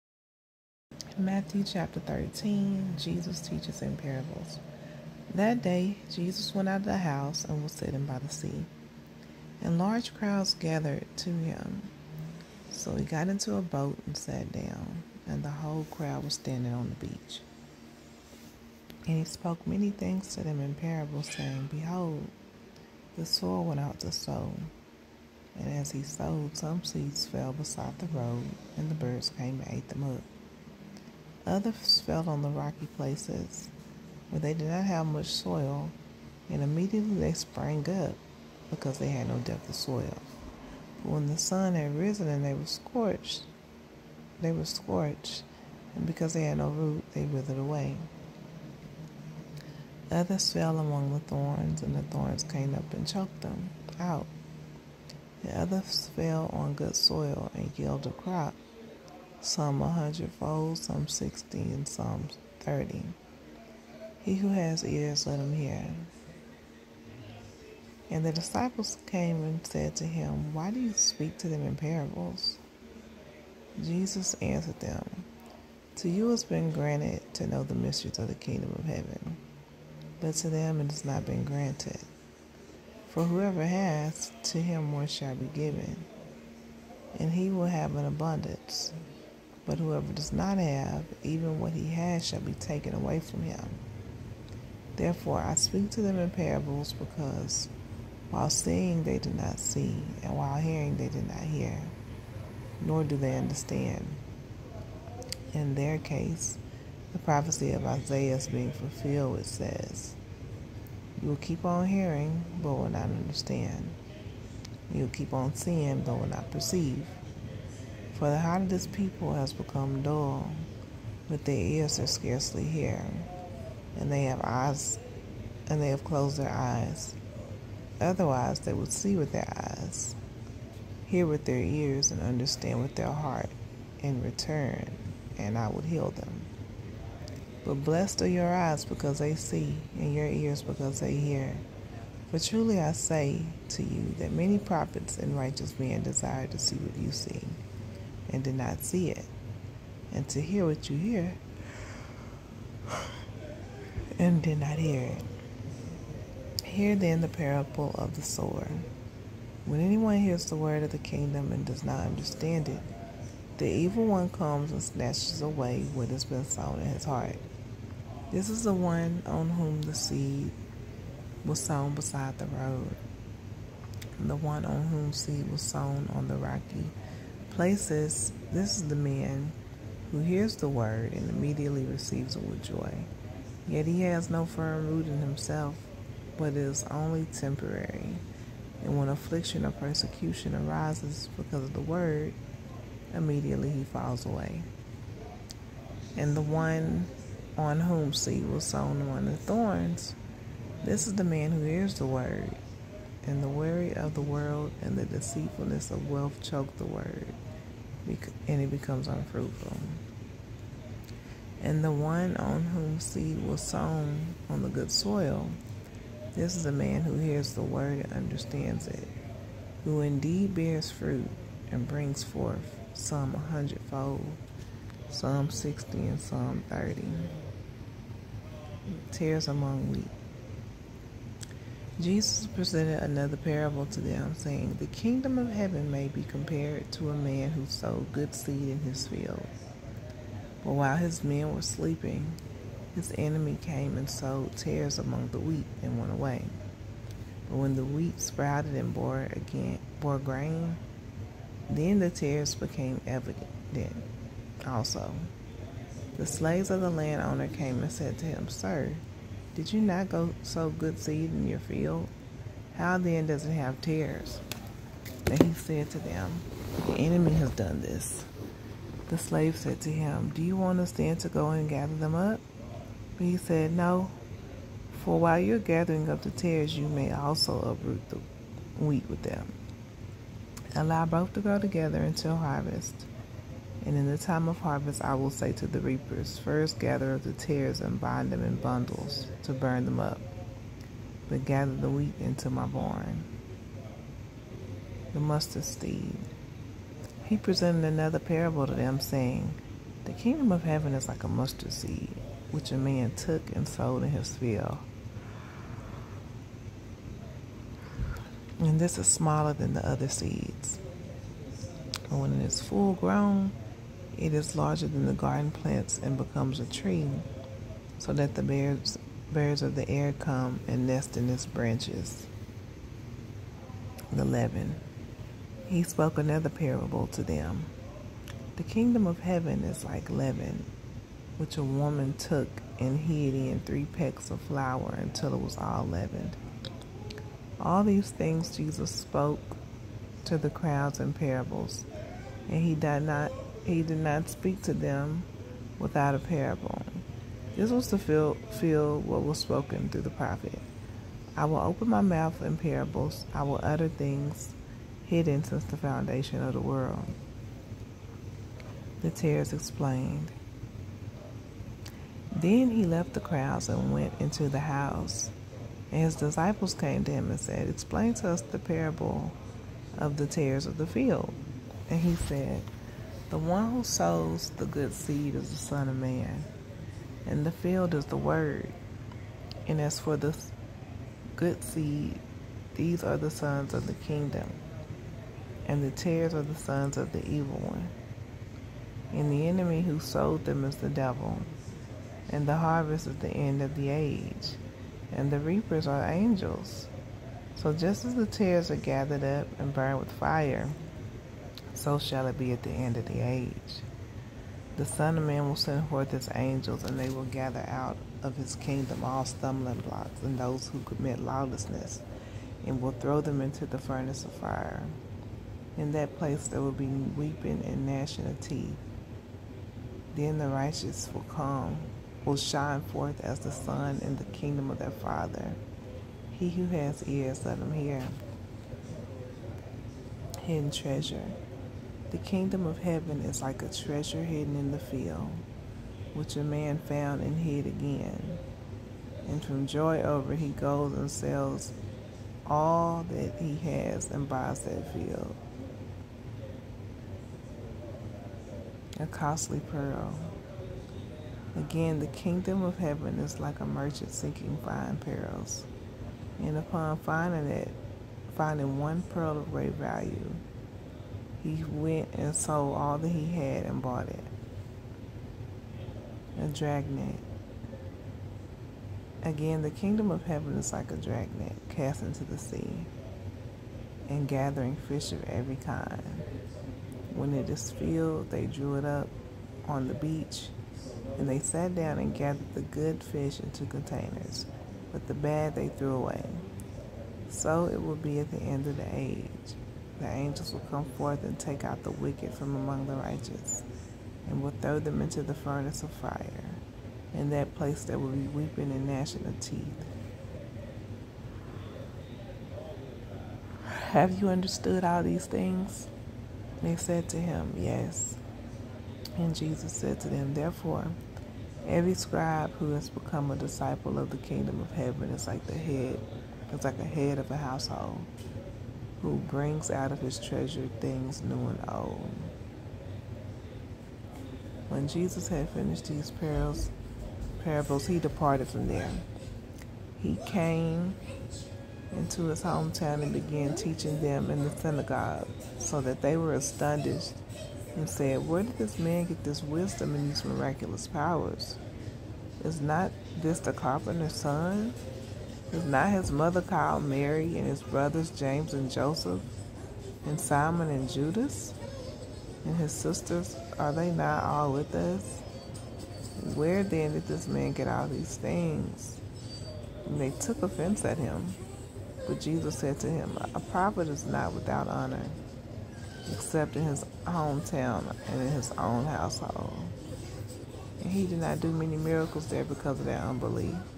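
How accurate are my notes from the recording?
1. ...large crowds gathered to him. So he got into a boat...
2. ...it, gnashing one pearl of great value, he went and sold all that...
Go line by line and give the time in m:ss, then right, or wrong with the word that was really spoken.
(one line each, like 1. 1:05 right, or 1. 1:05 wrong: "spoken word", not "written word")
1. 0:09 right
2. 7:37 wrong: "finding", not "gnashing".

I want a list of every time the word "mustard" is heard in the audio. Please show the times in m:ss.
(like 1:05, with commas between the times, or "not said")
4:55, 5:01.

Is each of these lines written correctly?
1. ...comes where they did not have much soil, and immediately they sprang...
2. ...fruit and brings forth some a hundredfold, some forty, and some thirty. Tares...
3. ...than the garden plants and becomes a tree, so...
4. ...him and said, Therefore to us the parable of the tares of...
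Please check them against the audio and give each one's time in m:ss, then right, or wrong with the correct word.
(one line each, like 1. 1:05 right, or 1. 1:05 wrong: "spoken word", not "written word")
1. 0:32 wrong: "places", not "comes"
2. 3:40 wrong: "sixty", not "forty"
3. 5:14 right
4. 6:07 wrong: "Explain", not "Therefore".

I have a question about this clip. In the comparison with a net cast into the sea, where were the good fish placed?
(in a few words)
containers.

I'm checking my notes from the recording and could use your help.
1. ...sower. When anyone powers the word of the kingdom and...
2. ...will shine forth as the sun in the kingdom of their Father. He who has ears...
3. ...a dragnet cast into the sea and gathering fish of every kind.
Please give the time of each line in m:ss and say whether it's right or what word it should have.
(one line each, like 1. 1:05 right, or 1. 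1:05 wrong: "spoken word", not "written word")
1. 2:38 wrong: "hears", not "powers"
2. 7:02 right
3. 7:50 right.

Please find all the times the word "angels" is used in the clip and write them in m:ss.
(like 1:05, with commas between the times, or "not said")
6:36, 6:46, 8:10.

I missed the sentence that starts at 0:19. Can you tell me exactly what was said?
And he spoke many things to them in parables, saying, Behold, the soil went out to sow.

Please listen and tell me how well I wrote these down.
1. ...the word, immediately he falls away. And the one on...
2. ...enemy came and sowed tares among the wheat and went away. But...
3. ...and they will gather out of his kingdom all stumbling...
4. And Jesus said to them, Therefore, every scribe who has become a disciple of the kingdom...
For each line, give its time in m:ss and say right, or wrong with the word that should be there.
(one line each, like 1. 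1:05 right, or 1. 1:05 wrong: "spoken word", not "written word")
1. 3:11 right
2. 4:03 right
3. 6:46 right
4. 8:29 right.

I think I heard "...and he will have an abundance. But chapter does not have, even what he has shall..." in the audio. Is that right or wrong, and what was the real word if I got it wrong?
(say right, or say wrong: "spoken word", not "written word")
wrong: "whoever", not "chapter".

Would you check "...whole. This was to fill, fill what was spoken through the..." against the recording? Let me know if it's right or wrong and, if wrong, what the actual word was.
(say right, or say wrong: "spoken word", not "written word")
wrong: "parable", not "whole".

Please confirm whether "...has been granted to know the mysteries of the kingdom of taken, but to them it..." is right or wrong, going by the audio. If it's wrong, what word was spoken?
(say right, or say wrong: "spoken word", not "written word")
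wrong: "heaven", not "taken".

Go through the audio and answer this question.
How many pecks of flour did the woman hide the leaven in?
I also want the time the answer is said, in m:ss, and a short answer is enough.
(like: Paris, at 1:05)
3, at 5:33.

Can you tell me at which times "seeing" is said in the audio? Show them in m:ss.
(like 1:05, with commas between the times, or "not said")
1:38, 1:55.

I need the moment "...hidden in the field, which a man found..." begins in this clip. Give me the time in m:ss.
7:14.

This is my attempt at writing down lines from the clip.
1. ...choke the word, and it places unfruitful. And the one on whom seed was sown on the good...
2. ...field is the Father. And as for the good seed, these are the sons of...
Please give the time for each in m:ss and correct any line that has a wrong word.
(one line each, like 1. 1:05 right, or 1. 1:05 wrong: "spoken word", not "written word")
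1. 3:26 wrong: "becomes", not "places"
2. 6:17 wrong: "Word", not "Father".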